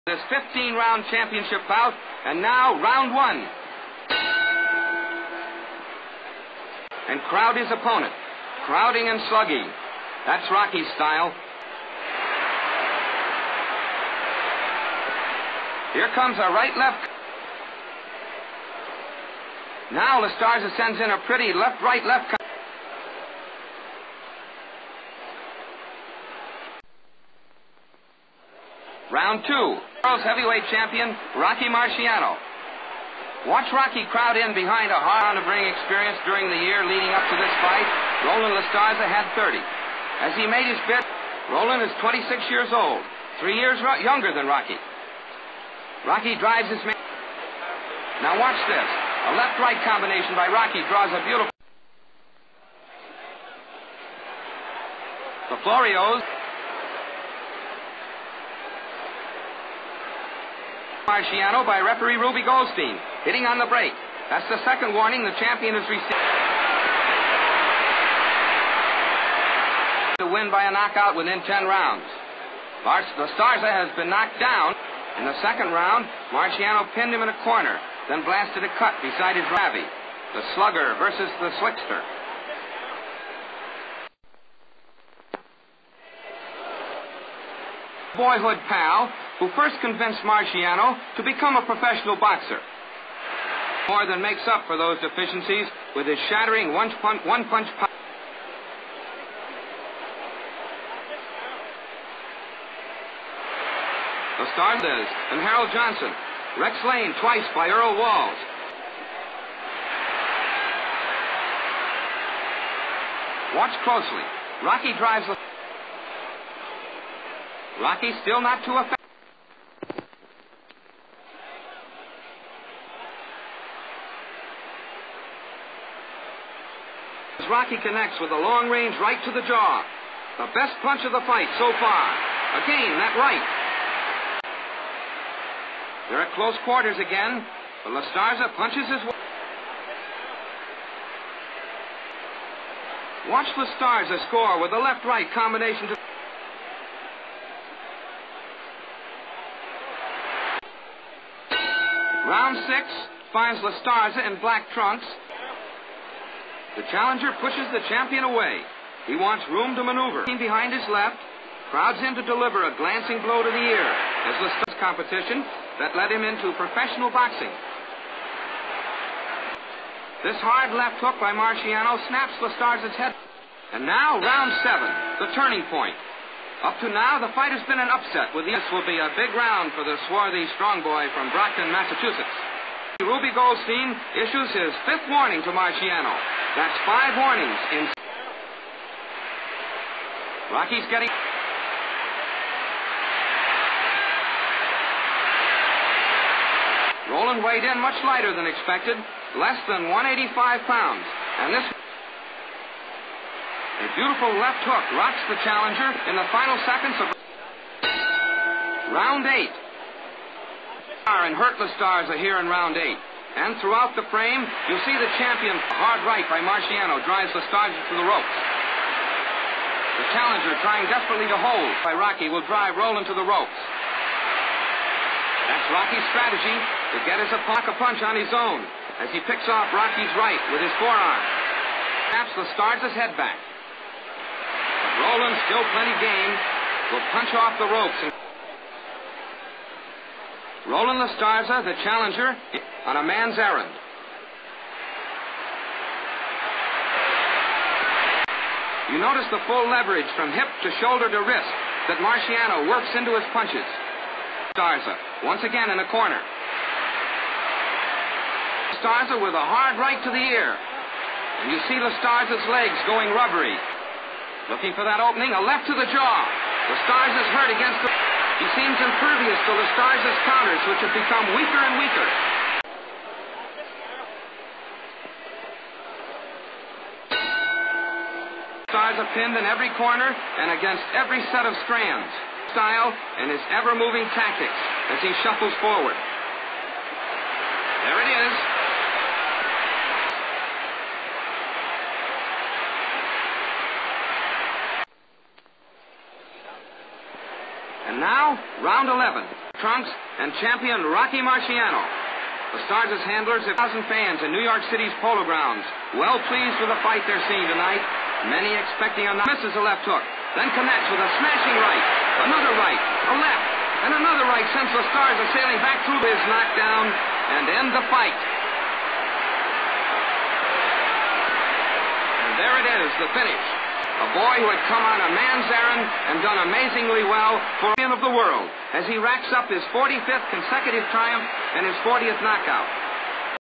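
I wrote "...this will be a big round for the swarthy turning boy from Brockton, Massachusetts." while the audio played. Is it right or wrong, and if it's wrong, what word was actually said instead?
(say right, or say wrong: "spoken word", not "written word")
wrong: "strong", not "turning".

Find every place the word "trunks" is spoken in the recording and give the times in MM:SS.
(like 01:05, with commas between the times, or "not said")
02:34, 04:59.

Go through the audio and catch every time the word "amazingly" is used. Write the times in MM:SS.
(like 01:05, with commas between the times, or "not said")
05:26.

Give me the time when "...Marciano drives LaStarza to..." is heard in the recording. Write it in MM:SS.
03:36.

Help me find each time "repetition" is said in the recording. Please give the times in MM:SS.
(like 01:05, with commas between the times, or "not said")
not said.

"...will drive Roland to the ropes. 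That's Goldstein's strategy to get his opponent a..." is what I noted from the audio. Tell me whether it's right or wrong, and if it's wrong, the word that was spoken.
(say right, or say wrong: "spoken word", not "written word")
wrong: "Rocky", not "Goldstein".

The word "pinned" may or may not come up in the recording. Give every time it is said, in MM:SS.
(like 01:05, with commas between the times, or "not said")
01:16, 04:39.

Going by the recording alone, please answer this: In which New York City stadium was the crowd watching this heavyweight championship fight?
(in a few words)
Polo Grounds.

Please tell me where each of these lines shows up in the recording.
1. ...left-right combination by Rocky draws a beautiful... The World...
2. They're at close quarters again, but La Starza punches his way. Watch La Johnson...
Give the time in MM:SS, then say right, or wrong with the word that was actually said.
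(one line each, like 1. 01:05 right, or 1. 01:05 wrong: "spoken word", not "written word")
1. 00:49 wrong: "Florios", not "World"
2. 02:16 wrong: "Starza", not "Johnson".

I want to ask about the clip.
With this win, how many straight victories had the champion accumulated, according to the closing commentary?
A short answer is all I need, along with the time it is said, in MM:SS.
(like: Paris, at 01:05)
45, at 05:29.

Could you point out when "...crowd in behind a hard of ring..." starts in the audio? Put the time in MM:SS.
00:34.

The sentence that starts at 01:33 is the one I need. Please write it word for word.
More than makes up for those deficiencies with his shattering one punch, one punch power.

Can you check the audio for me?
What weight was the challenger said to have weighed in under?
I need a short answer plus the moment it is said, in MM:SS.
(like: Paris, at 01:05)
185 pounds, at 03:19.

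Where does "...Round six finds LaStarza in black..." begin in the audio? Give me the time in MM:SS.
02:32.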